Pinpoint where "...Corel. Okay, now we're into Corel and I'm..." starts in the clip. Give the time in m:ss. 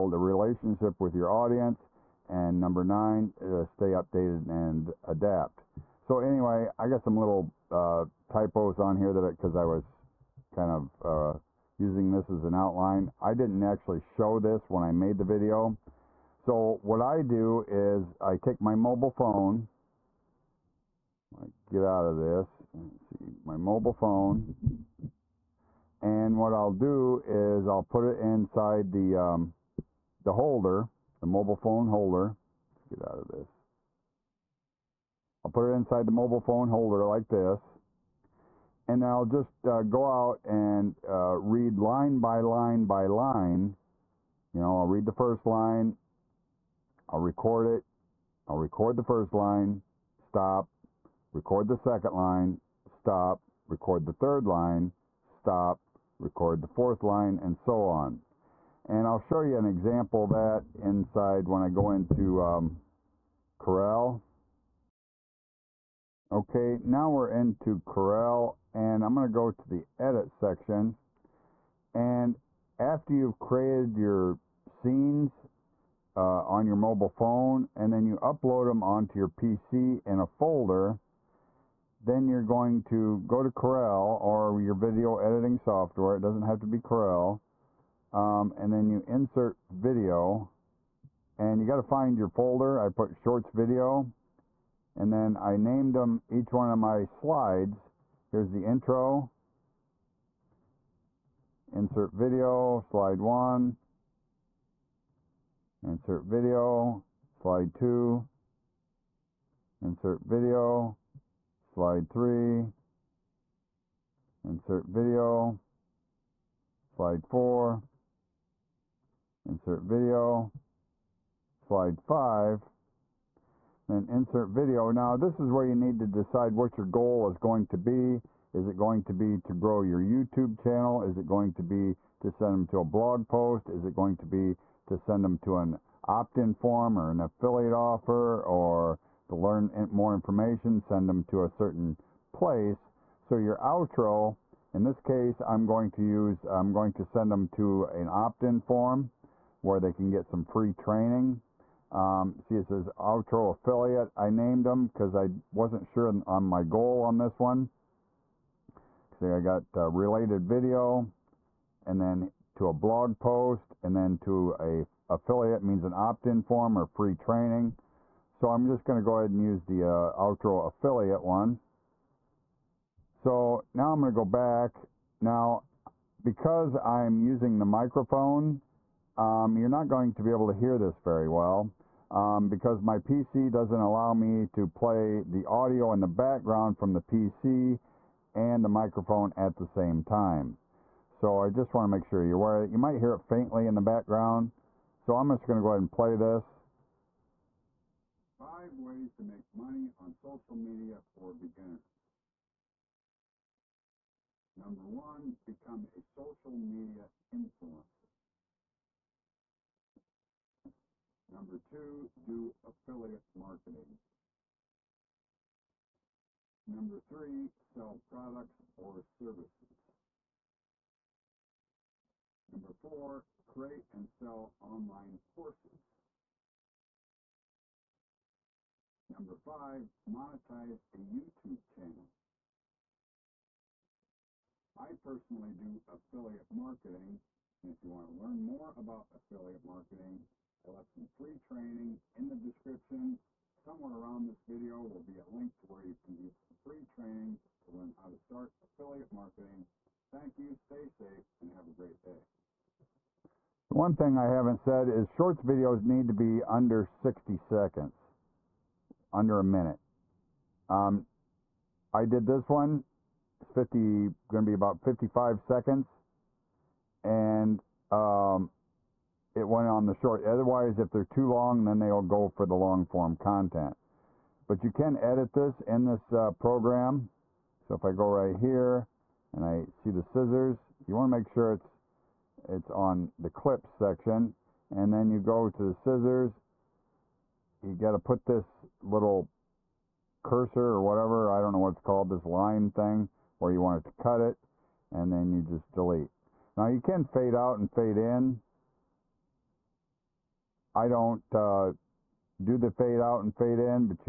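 1:03.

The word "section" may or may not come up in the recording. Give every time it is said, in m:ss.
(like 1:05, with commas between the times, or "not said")
1:10, 4:43.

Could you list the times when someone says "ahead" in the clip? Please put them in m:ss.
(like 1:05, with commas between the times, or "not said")
2:49, 3:15.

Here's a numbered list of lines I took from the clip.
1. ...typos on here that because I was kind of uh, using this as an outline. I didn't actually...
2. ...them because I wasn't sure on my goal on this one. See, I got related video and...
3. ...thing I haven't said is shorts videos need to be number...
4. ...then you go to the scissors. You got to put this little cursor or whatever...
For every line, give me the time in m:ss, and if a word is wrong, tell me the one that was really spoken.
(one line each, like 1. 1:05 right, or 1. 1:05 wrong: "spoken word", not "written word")
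1. 0:08 right
2. 2:34 right
3. 4:13 wrong: "under", not "number"
4. 4:44 right.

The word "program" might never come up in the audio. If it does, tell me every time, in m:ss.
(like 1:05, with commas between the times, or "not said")
4:36.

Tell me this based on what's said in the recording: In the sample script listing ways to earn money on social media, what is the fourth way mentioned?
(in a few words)
create and sell online courses.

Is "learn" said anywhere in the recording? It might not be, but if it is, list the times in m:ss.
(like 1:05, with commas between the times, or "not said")
2:19, 3:58, 4:07.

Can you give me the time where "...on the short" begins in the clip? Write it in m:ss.
4:29.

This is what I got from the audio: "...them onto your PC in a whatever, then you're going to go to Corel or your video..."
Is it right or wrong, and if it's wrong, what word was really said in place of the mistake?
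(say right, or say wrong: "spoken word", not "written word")
wrong: "folder", not "whatever".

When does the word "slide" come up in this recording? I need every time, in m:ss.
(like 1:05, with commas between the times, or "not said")
1:37, 1:42, 1:47, 1:51, 1:56, 2:01.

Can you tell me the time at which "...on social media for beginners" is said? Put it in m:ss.
3:20.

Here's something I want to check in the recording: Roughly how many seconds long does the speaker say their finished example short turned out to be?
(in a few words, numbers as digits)
55 seconds.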